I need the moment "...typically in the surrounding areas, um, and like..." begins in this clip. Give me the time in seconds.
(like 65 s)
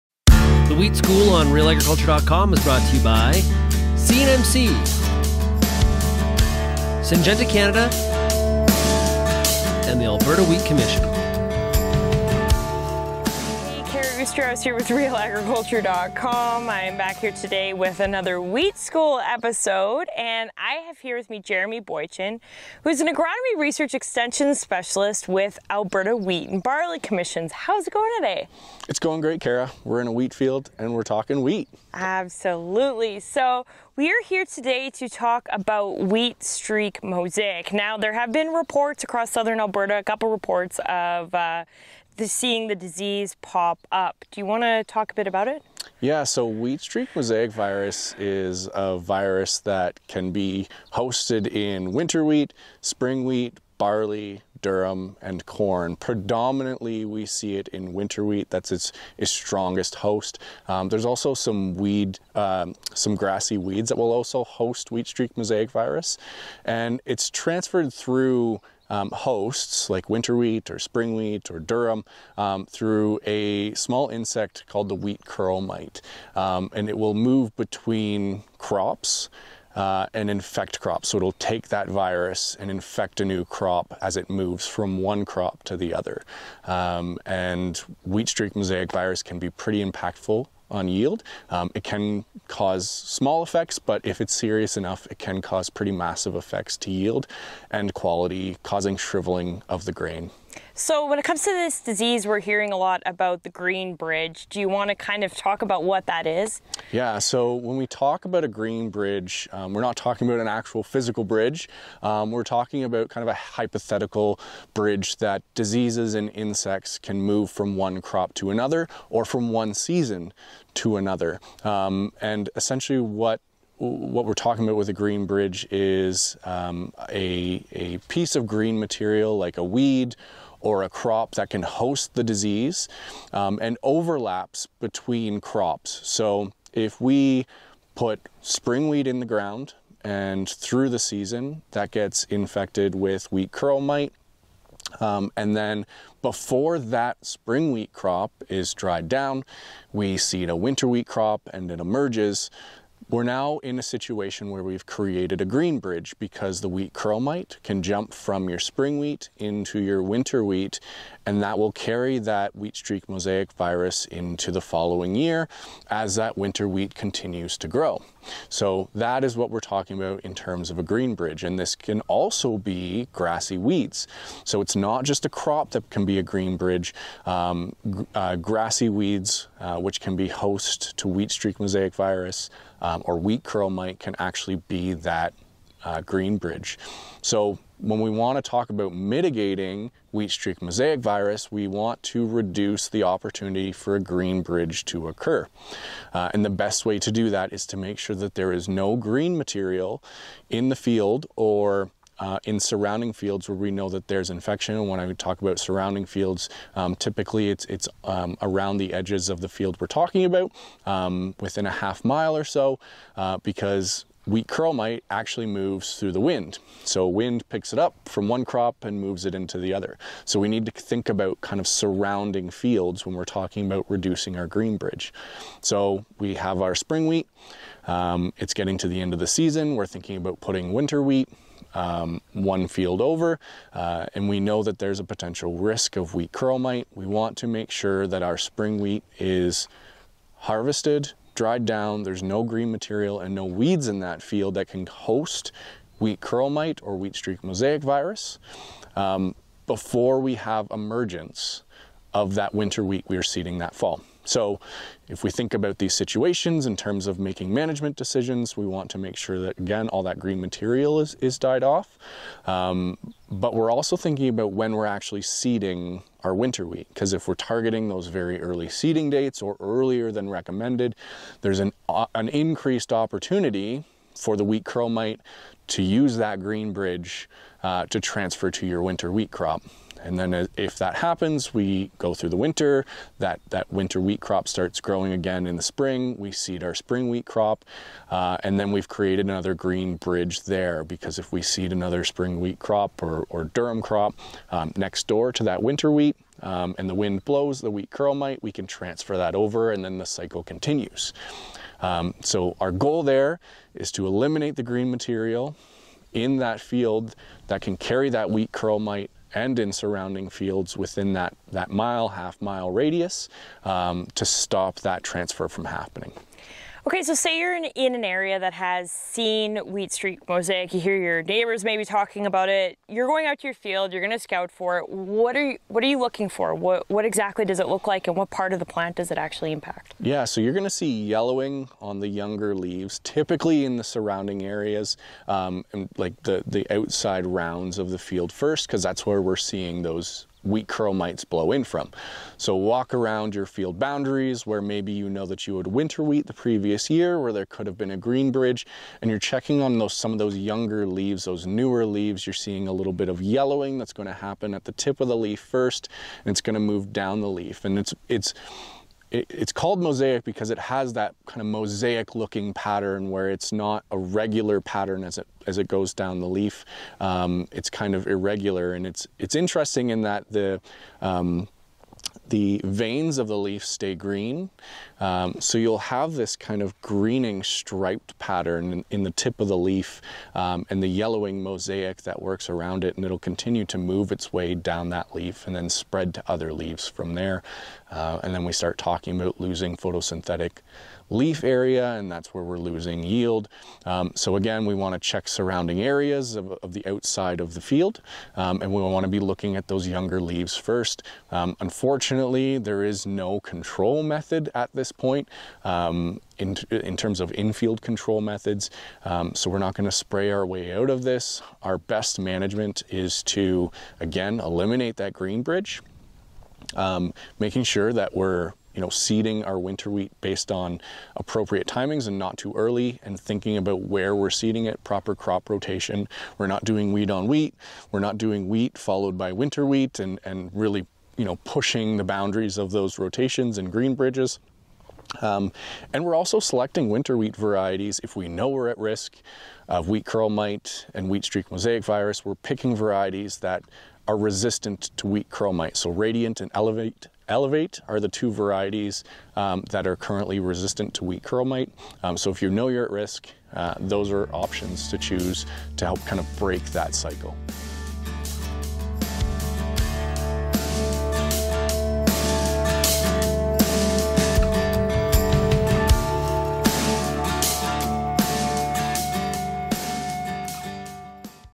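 333 s.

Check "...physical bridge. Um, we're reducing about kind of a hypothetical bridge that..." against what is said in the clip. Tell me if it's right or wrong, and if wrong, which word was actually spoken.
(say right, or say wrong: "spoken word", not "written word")
wrong: "talking", not "reducing".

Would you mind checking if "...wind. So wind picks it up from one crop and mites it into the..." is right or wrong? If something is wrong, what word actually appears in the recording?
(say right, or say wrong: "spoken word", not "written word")
wrong: "moves", not "mites".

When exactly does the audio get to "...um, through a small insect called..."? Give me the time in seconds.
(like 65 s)
72 s.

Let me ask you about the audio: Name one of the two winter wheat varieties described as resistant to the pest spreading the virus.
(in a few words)
Radiant.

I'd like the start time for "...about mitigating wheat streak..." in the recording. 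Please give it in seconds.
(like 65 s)
188 s.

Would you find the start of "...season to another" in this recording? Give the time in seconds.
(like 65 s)
119 s.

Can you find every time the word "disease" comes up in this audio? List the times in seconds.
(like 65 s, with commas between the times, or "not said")
42 s, 101 s, 115 s, 132 s.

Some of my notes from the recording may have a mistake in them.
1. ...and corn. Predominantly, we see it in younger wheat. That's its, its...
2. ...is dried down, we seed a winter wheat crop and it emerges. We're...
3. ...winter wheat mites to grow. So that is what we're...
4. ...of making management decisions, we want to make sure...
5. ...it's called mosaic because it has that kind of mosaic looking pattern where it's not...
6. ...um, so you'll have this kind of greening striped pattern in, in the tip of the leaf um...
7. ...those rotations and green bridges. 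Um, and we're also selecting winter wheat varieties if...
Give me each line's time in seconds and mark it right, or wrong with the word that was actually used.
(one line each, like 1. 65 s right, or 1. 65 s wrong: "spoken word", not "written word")
1. 55 s wrong: "winter", not "younger"
2. 148 s right
3. 166 s wrong: "continues", not "mites"
4. 257 s right
5. 359 s right
6. 375 s right
7. 432 s right.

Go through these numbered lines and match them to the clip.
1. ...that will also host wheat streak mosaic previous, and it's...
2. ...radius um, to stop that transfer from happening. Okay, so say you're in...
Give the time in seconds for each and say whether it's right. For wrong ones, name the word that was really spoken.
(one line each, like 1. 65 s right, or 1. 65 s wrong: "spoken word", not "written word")
1. 63 s wrong: "virus", not "previous"
2. 312 s right.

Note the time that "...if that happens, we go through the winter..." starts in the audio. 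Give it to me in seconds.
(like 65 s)
280 s.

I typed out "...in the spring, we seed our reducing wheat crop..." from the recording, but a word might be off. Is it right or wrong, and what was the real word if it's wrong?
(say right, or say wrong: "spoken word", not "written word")
wrong: "spring", not "reducing".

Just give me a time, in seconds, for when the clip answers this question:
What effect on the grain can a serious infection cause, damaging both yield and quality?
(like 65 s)
98 s.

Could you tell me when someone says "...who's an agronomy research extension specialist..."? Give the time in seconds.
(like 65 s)
22 s.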